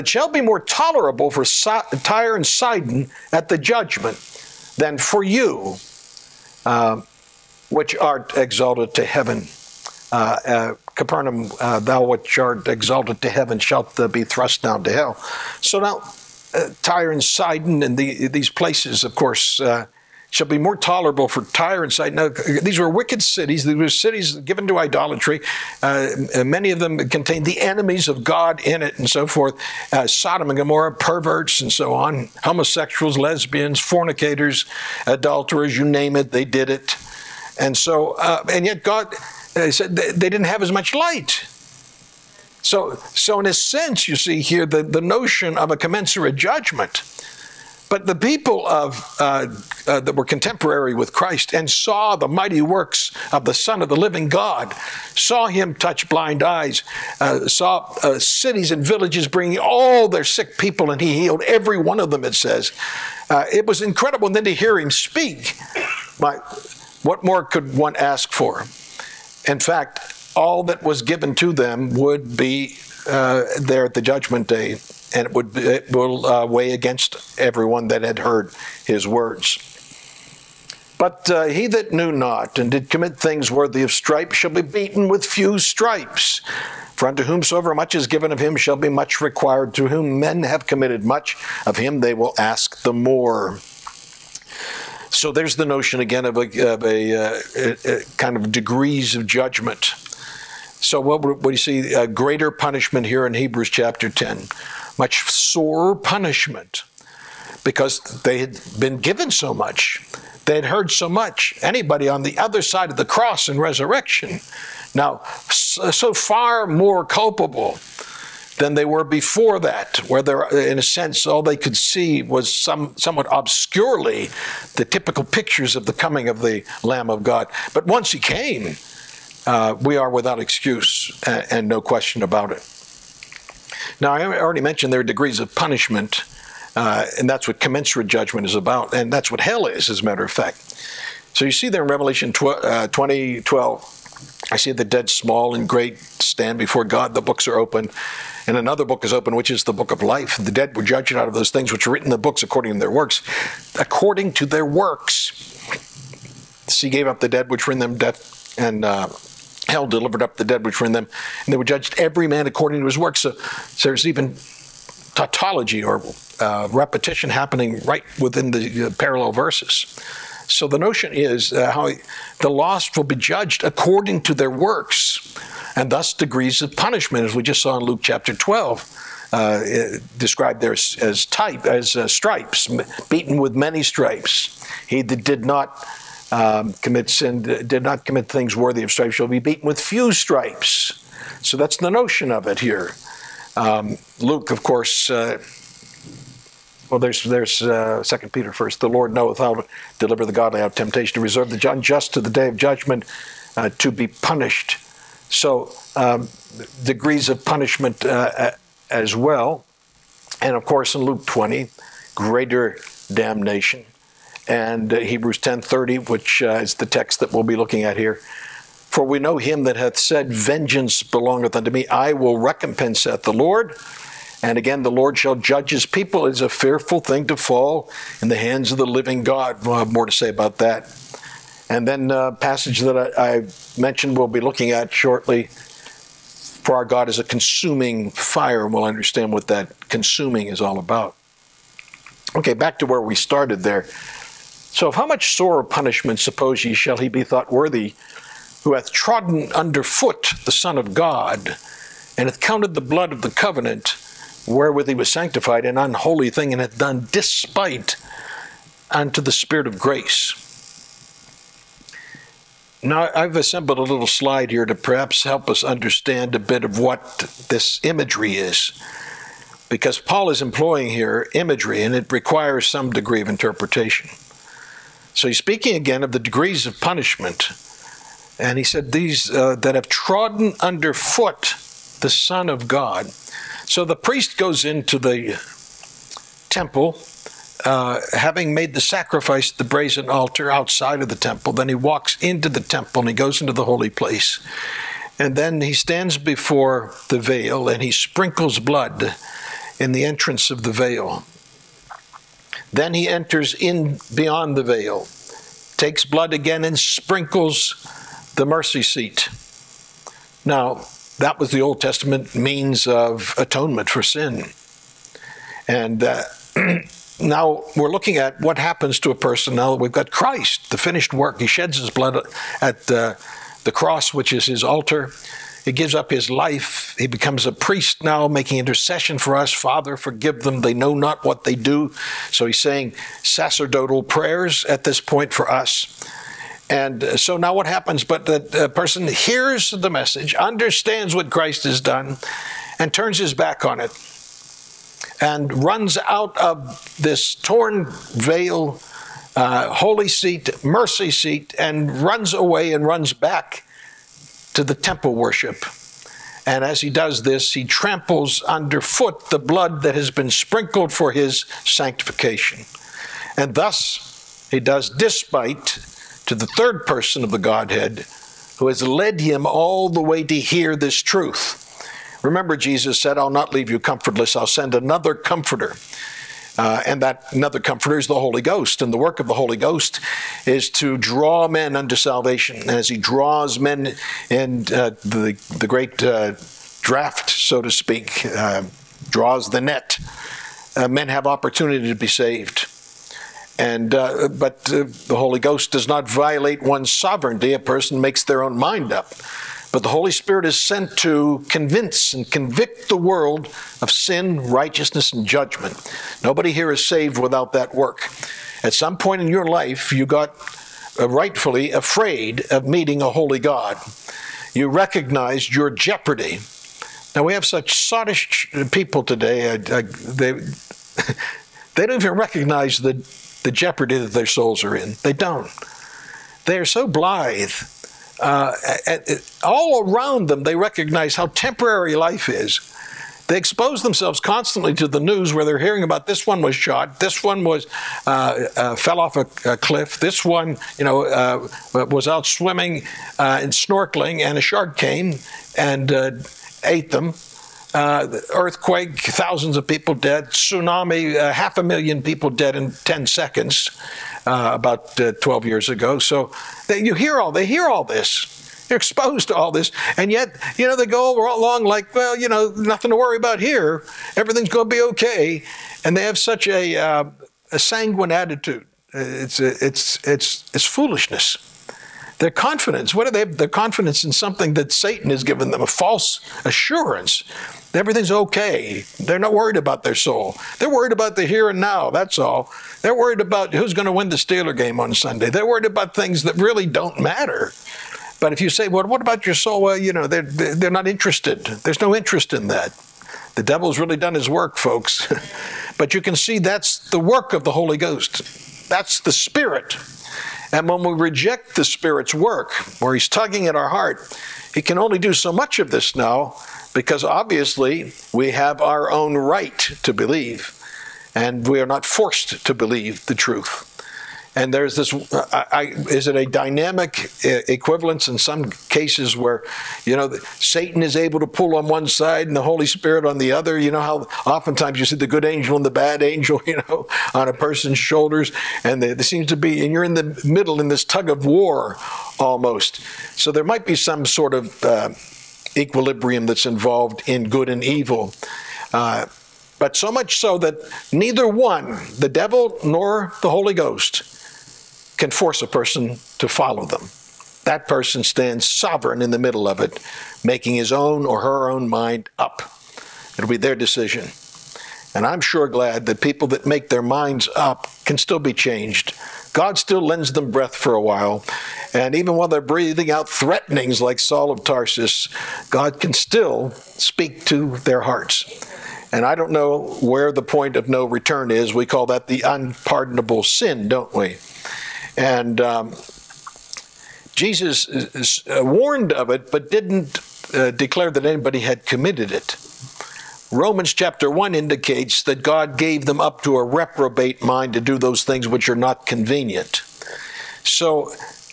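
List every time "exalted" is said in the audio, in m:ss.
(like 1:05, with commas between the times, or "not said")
0:08, 0:12.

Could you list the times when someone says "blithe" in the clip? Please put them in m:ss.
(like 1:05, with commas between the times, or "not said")
7:06.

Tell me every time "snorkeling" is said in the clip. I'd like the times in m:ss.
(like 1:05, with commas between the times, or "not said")
7:23.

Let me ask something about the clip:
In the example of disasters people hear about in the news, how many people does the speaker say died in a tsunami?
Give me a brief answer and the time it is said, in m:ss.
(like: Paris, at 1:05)
half a million, at 7:31.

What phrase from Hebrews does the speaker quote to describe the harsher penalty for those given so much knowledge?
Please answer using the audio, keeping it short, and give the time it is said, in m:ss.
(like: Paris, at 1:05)
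much sorer punishment, at 1:44.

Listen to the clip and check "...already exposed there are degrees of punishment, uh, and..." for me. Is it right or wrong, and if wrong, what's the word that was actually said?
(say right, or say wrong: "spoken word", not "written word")
wrong: "mentioned", not "exposed".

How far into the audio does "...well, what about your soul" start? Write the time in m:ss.
8:08.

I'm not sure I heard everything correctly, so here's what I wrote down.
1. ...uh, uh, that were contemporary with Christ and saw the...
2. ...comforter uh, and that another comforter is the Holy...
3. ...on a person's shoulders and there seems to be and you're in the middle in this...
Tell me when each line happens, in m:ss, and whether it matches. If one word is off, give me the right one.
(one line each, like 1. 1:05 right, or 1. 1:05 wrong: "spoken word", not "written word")
1. 0:49 right
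2. 6:15 right
3. 8:47 right.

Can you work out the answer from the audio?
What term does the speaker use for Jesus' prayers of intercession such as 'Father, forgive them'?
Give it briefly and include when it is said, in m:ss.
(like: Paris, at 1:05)
sacerdotal prayers, at 5:33.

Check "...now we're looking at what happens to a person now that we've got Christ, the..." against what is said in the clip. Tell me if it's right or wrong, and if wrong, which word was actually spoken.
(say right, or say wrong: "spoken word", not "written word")
right.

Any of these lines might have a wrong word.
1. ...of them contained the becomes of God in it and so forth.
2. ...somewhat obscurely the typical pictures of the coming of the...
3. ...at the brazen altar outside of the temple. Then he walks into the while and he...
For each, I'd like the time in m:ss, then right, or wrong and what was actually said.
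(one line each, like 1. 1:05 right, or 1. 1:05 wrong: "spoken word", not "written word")
1. 0:26 wrong: "enemies", not "becomes"
2. 2:02 right
3. 4:49 wrong: "temple", not "while".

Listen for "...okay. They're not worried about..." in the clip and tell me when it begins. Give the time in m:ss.
7:58.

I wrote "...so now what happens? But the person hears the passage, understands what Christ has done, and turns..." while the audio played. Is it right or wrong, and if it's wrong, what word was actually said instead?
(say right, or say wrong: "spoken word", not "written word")
wrong: "message", not "passage".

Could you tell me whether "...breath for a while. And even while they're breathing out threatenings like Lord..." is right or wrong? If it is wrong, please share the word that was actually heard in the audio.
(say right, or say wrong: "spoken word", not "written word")
wrong: "Saul", not "Lord".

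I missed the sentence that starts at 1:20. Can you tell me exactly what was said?
But uh, he that knew not and did commit things worthy of stripes shall be beaten with few stripes.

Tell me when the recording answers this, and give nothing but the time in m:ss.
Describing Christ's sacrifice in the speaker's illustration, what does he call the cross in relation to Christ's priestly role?
5:24.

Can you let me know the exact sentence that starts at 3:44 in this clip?
And again, the Lord shall judge his people.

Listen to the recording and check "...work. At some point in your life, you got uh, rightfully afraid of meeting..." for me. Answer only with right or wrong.
right.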